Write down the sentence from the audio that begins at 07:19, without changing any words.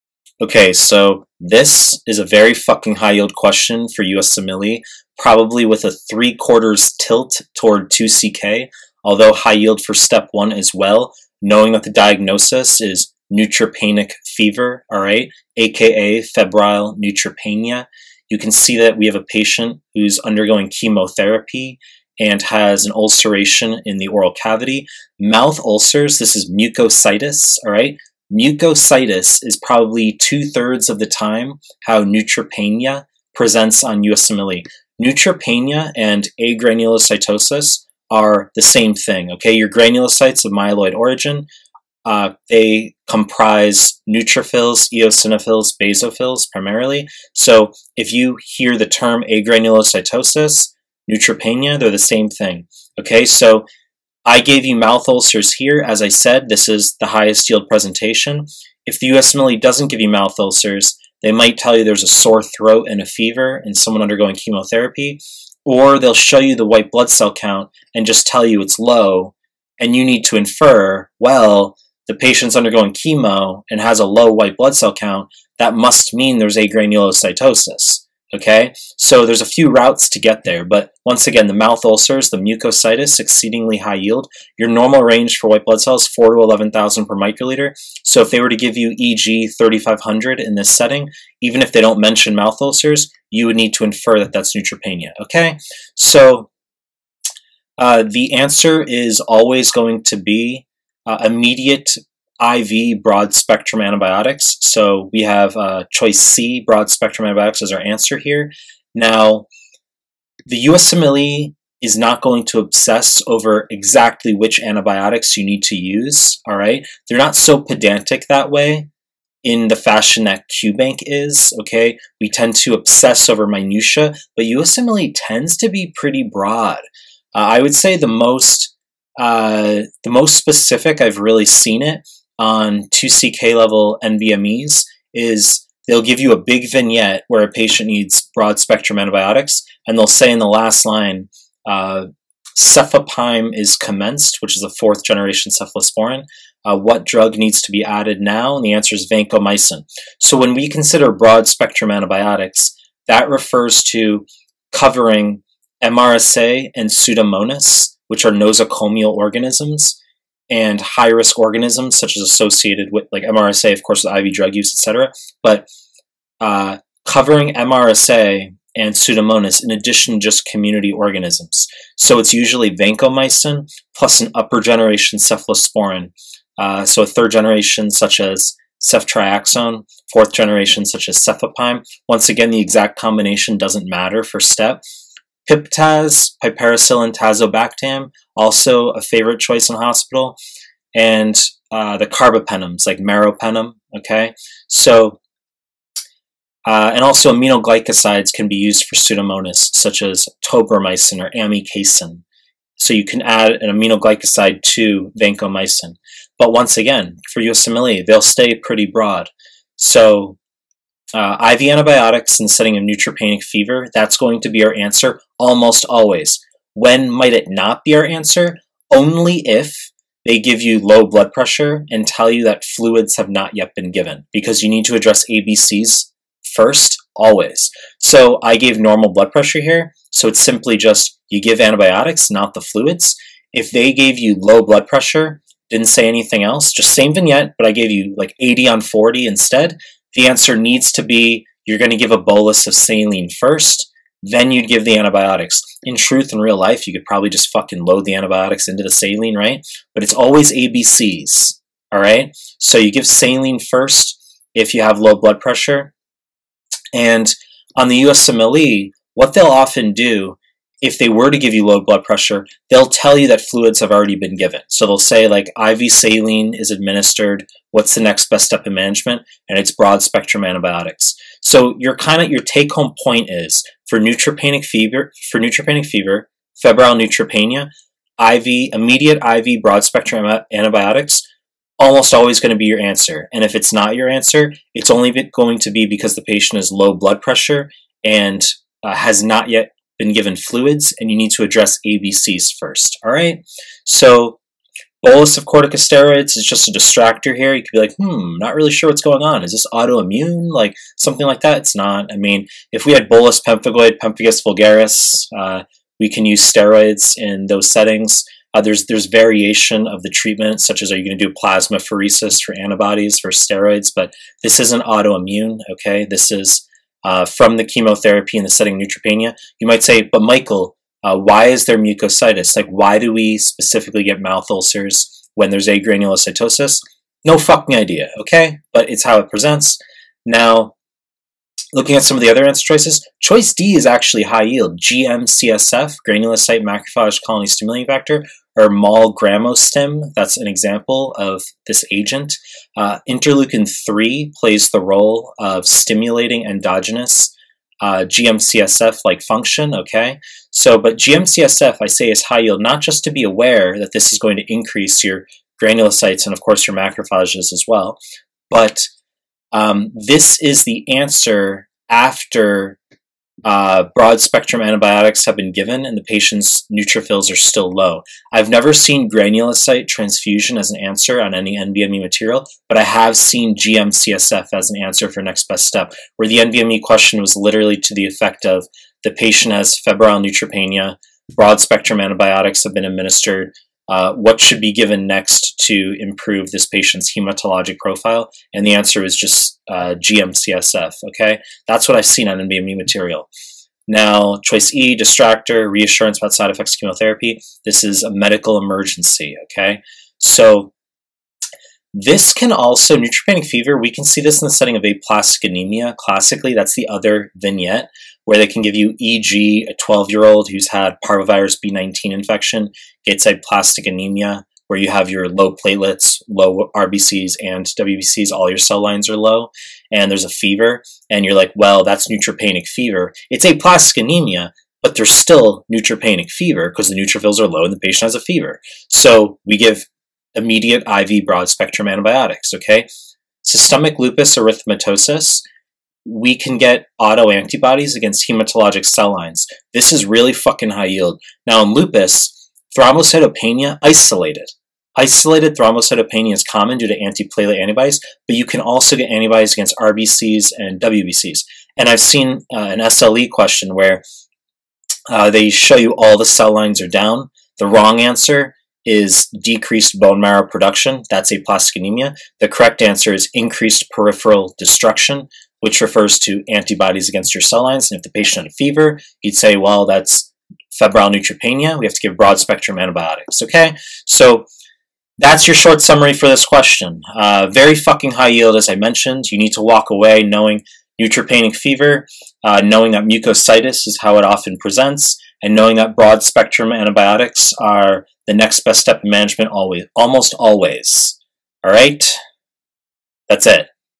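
This is really fucking high yield.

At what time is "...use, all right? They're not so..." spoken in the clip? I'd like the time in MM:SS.
01:55.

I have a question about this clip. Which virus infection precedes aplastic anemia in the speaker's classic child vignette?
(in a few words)
parvovirus B19.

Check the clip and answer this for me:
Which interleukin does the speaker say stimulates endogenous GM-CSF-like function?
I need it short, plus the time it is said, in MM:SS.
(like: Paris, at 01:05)
interleukin 3, at 05:43.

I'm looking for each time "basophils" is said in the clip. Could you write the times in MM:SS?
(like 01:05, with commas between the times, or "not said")
00:45.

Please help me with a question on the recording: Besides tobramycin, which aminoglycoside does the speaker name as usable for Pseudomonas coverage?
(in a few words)
amikacin.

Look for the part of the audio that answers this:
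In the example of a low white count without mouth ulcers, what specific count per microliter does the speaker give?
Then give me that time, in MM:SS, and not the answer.
01:29.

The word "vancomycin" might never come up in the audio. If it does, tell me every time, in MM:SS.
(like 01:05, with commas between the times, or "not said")
02:29, 02:52, 03:25.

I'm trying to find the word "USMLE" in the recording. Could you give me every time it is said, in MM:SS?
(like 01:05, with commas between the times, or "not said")
00:04, 00:34, 00:59, 01:50, 02:04, 03:27, 04:18.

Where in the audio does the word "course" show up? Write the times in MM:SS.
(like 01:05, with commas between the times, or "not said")
02:43, 05:56.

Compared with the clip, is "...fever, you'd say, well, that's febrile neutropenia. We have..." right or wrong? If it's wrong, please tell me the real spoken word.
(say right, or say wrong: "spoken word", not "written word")
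right.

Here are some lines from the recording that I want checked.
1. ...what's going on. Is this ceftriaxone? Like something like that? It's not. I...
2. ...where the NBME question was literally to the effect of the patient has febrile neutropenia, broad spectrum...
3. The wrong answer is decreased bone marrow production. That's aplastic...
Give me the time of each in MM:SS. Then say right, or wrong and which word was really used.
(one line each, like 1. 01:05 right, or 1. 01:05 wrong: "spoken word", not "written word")
1. 04:58 wrong: "autoimmune", not "ceftriaxone"
2. 06:16 right
3. 07:37 right.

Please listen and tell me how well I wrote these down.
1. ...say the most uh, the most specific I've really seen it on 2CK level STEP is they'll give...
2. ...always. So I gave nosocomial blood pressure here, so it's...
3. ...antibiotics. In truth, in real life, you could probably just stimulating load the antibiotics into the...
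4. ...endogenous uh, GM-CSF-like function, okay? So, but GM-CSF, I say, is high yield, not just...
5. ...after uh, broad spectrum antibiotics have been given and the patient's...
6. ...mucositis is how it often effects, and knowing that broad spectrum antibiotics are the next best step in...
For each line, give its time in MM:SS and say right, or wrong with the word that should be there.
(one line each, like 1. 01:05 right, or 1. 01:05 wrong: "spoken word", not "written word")
1. 02:07 wrong: "NBMEs", not "STEP"
2. 03:47 wrong: "normal", not "nosocomial"
3. 04:04 wrong: "fucking", not "stimulating"
4. 05:46 right
5. 06:01 right
6. 08:03 wrong: "presents", not "effects".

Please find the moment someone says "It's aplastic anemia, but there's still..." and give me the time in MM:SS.
07:03.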